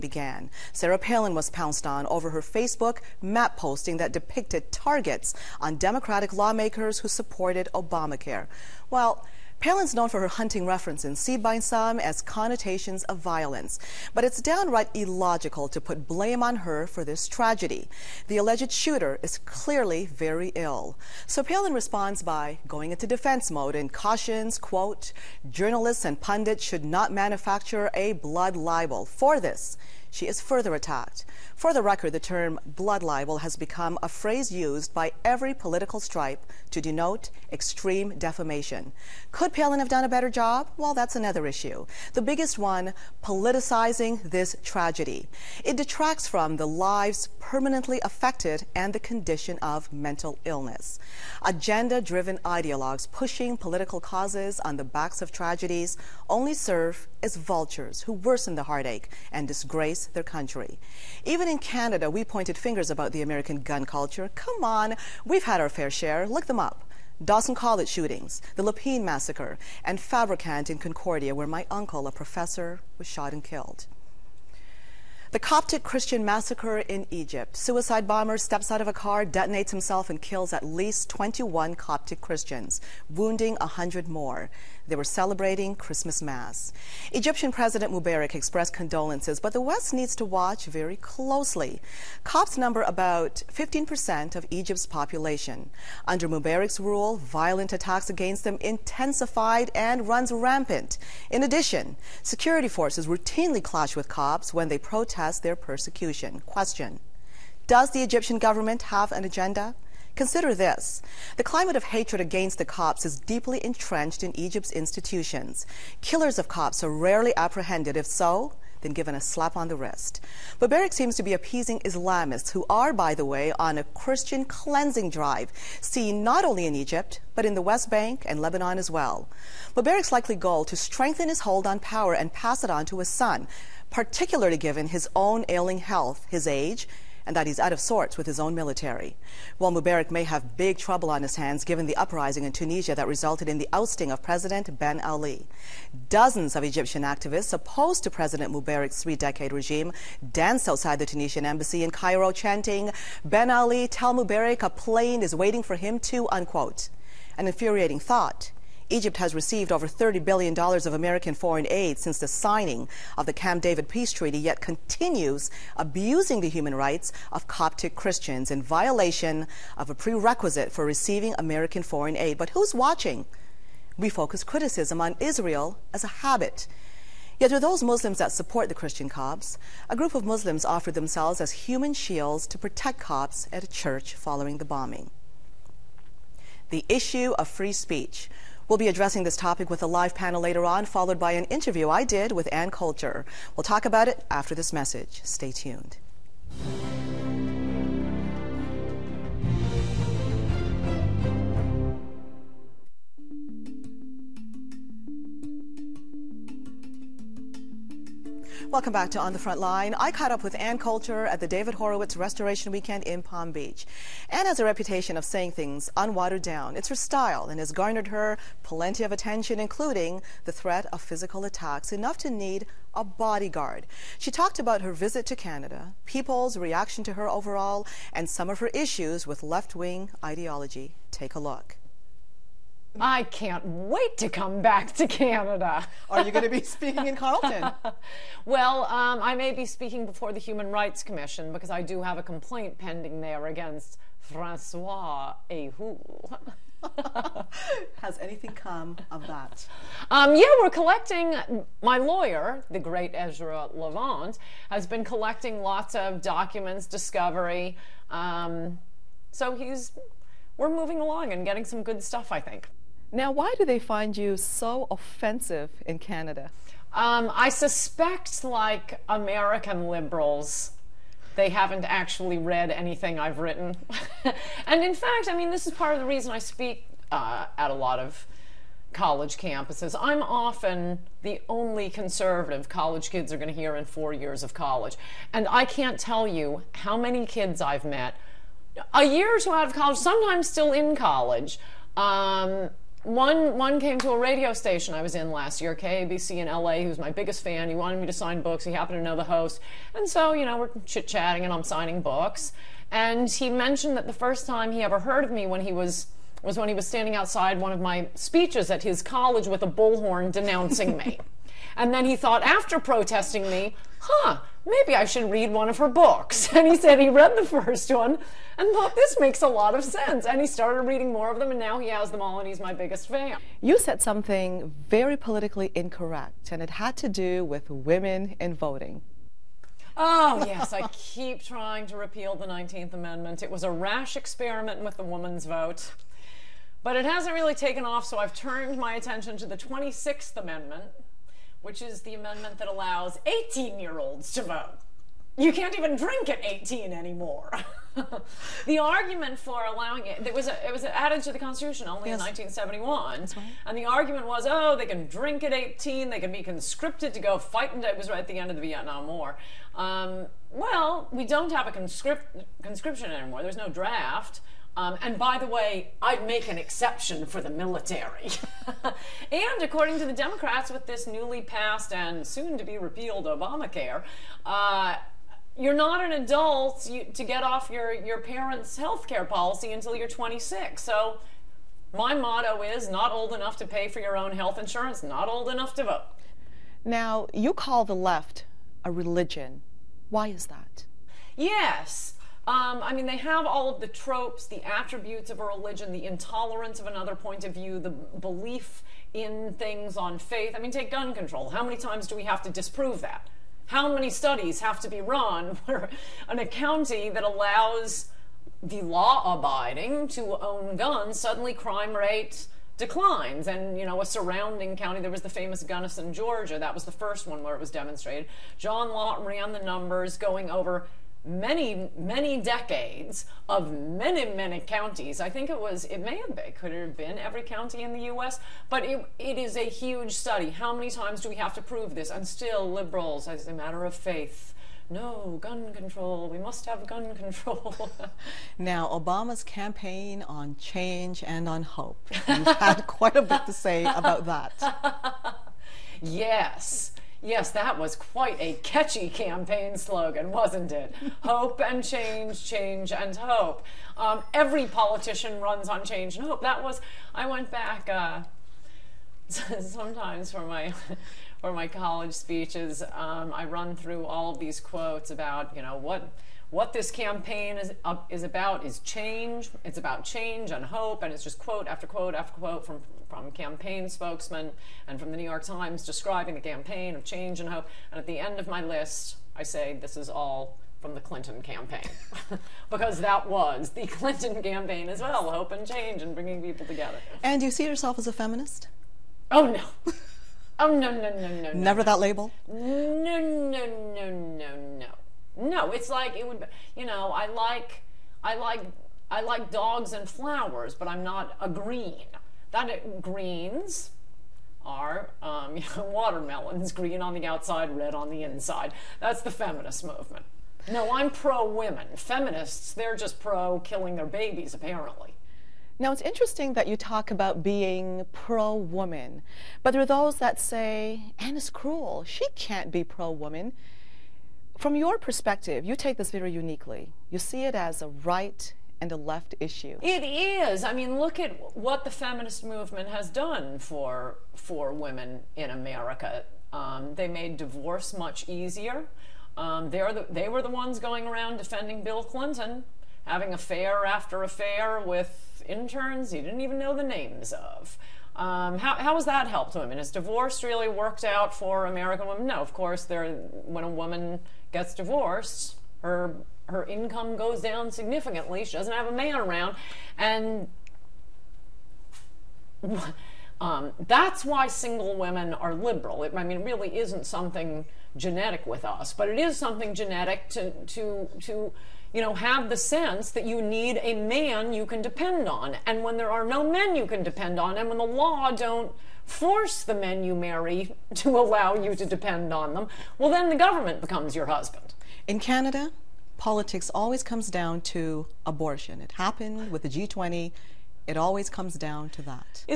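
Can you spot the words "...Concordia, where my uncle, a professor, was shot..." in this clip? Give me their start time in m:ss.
1:10.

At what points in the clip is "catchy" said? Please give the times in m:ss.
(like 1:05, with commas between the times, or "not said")
7:28.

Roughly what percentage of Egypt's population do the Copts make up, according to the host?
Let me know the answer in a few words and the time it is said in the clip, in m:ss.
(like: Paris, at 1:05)
15%, at 1:33.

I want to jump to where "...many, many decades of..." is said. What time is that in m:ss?
7:01.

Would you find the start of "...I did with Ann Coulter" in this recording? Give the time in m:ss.
3:11.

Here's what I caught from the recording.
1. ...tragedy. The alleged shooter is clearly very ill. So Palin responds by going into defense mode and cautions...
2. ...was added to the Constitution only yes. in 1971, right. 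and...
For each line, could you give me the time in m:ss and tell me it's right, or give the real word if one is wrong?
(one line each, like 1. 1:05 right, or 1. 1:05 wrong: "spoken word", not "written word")
1. 0:17 right
2. 5:50 right.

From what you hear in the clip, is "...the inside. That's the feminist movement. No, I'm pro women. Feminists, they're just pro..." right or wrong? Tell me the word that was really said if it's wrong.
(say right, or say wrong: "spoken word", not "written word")
right.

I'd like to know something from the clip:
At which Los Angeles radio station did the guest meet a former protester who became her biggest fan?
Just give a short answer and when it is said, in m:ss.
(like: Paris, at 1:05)
KABC, at 4:55.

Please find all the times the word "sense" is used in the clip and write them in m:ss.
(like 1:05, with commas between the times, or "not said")
5:19, 9:32.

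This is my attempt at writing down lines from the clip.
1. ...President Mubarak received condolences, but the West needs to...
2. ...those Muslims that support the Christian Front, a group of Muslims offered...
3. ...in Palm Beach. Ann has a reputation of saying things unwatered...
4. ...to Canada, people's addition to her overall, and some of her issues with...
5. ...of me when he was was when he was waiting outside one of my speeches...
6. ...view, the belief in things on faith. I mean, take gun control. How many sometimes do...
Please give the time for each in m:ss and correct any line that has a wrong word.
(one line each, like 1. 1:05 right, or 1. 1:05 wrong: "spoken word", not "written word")
1. 1:27 wrong: "expressed", not "received"
2. 2:57 wrong: "Copts", not "Front"
3. 3:33 right
4. 3:45 wrong: "reaction", not "addition"
5. 5:05 wrong: "standing", not "waiting"
6. 6:37 wrong: "times", not "sometimes".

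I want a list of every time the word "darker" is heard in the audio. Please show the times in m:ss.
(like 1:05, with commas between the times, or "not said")
not said.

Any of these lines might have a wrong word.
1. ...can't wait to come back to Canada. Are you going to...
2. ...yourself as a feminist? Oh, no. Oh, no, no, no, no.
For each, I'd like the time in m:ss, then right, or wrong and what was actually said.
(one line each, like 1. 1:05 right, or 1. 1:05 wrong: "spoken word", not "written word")
1. 3:53 right
2. 8:07 right.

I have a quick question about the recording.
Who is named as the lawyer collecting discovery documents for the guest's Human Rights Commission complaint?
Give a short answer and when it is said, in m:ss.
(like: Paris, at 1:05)
Ezra Levant, at 4:13.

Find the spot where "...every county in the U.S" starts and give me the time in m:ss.
7:07.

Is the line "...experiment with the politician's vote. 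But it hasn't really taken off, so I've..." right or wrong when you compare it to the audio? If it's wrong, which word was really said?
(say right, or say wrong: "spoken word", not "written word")
wrong: "woman", not "politician".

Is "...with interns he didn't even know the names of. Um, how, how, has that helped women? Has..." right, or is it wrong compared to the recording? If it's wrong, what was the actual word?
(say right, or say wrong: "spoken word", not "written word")
right.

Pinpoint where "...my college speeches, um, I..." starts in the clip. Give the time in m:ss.
7:41.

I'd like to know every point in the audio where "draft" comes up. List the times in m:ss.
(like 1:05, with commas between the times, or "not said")
6:03.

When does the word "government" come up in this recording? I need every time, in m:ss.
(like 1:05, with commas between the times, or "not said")
1:48, 9:43.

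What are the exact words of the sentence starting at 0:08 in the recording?
Well, Palin's known for her hunting references, seen by some as connotations of violence.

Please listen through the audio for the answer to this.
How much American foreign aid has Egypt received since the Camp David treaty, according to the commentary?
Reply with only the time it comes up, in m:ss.
2:39.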